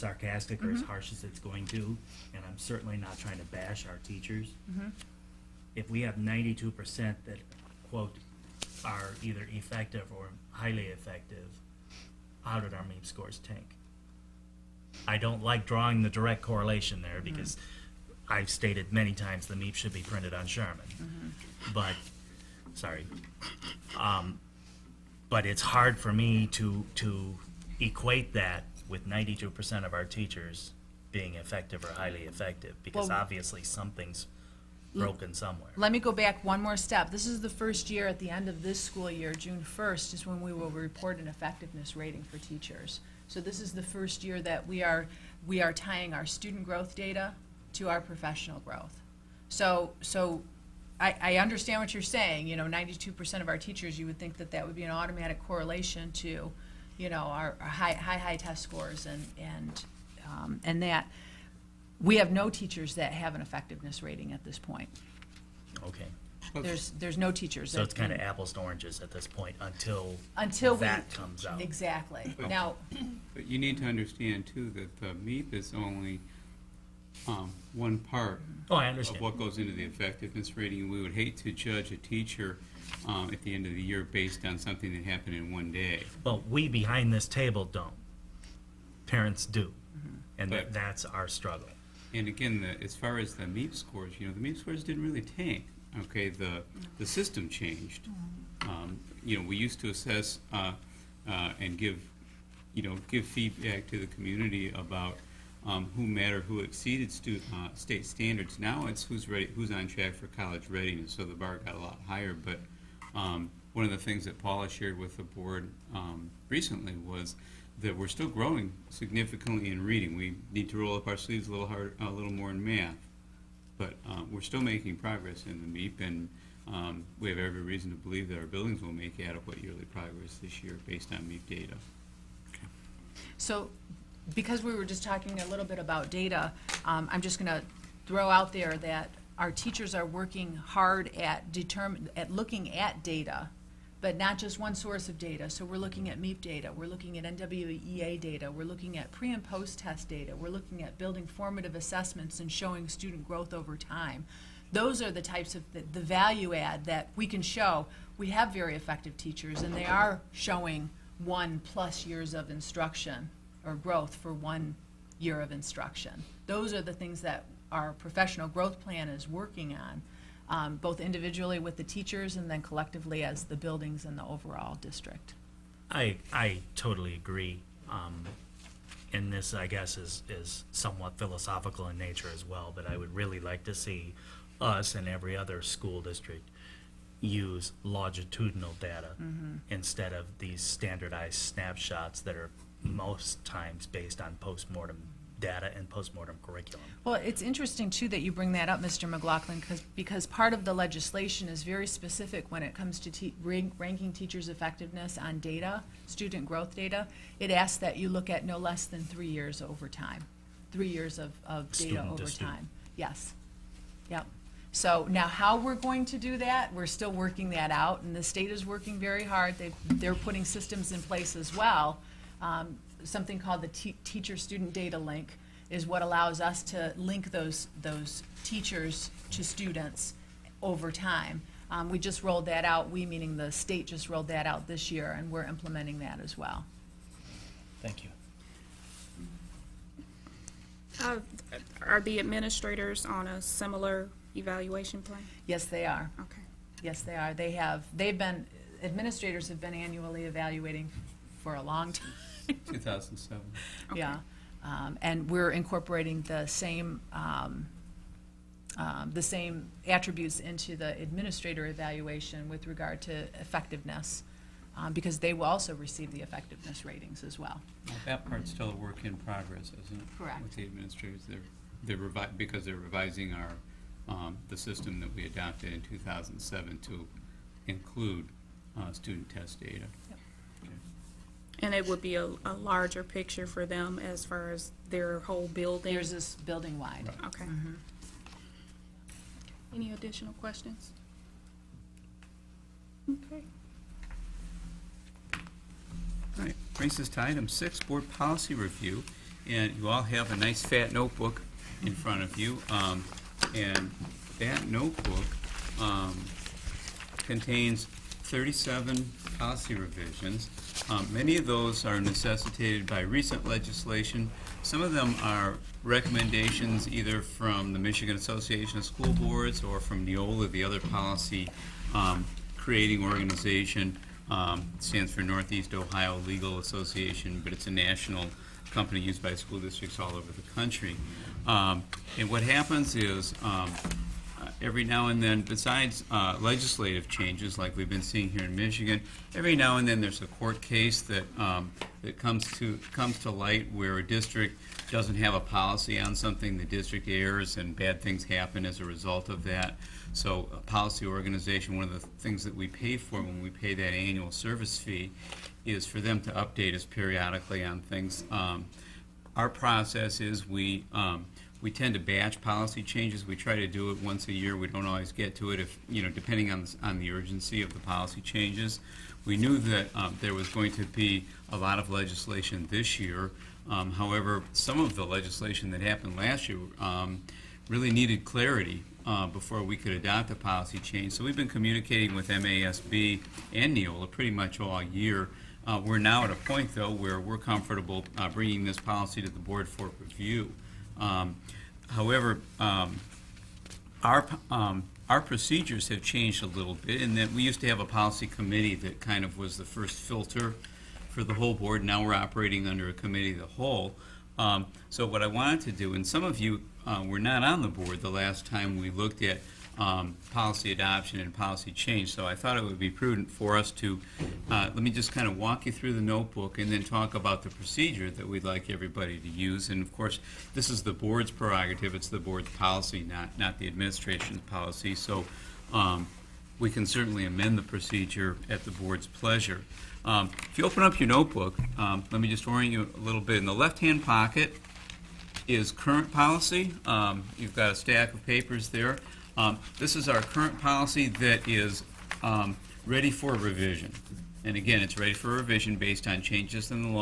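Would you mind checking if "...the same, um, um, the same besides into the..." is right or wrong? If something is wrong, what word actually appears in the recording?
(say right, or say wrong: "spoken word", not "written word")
wrong: "attributes", not "besides".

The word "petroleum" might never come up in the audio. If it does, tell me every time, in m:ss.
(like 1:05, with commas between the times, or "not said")
not said.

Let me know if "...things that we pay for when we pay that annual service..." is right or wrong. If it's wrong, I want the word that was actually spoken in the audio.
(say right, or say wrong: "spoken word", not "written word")
right.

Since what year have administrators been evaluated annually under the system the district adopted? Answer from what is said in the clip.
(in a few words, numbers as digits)
2007.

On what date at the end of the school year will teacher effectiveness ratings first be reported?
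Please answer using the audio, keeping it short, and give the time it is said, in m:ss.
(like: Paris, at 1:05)
June 1st, at 0:39.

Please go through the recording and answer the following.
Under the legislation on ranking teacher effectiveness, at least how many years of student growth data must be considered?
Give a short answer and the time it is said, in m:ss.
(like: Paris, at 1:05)
3 years, at 3:28.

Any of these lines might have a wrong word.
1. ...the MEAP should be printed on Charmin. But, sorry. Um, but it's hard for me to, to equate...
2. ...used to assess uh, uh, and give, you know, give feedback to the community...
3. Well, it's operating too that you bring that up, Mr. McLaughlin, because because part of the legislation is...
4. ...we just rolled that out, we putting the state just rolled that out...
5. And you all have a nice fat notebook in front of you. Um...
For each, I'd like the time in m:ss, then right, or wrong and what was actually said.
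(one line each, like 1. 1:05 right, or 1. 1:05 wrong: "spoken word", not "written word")
1. 0:19 right
2. 1:39 right
3. 3:17 wrong: "interesting", not "operating"
4. 3:51 wrong: "meaning", not "putting"
5. 4:59 right.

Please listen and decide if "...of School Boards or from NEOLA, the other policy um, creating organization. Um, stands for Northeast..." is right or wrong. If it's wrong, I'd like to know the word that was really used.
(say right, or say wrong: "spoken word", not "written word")
right.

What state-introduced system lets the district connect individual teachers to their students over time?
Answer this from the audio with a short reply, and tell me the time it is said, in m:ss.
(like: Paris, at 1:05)
teacher-student data link, at 3:44.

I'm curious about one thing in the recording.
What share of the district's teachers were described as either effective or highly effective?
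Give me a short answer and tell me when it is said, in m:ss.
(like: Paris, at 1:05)
92 percent, at 0:06.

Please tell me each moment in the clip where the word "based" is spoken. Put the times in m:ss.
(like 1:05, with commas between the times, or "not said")
1:24, 2:10, 3:13, 7:25.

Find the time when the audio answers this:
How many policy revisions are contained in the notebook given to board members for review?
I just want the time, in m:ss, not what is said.
5:08.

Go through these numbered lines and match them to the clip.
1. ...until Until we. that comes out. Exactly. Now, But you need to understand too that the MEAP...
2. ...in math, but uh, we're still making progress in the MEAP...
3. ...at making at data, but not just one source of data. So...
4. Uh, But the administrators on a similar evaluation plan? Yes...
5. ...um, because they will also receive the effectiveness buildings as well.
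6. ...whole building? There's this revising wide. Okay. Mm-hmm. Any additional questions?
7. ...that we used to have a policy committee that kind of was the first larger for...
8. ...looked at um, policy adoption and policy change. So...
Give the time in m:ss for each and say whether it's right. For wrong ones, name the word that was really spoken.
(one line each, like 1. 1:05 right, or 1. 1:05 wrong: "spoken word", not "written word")
1. 1:09 right
2. 2:02 right
3. 2:22 wrong: "looking", not "making"
4. 4:01 wrong: "Are", not "But"
5. 4:24 wrong: "ratings", not "buildings"
6. 4:45 wrong: "building", not "revising"
7. 6:37 wrong: "filter", not "larger"
8. 6:48 right.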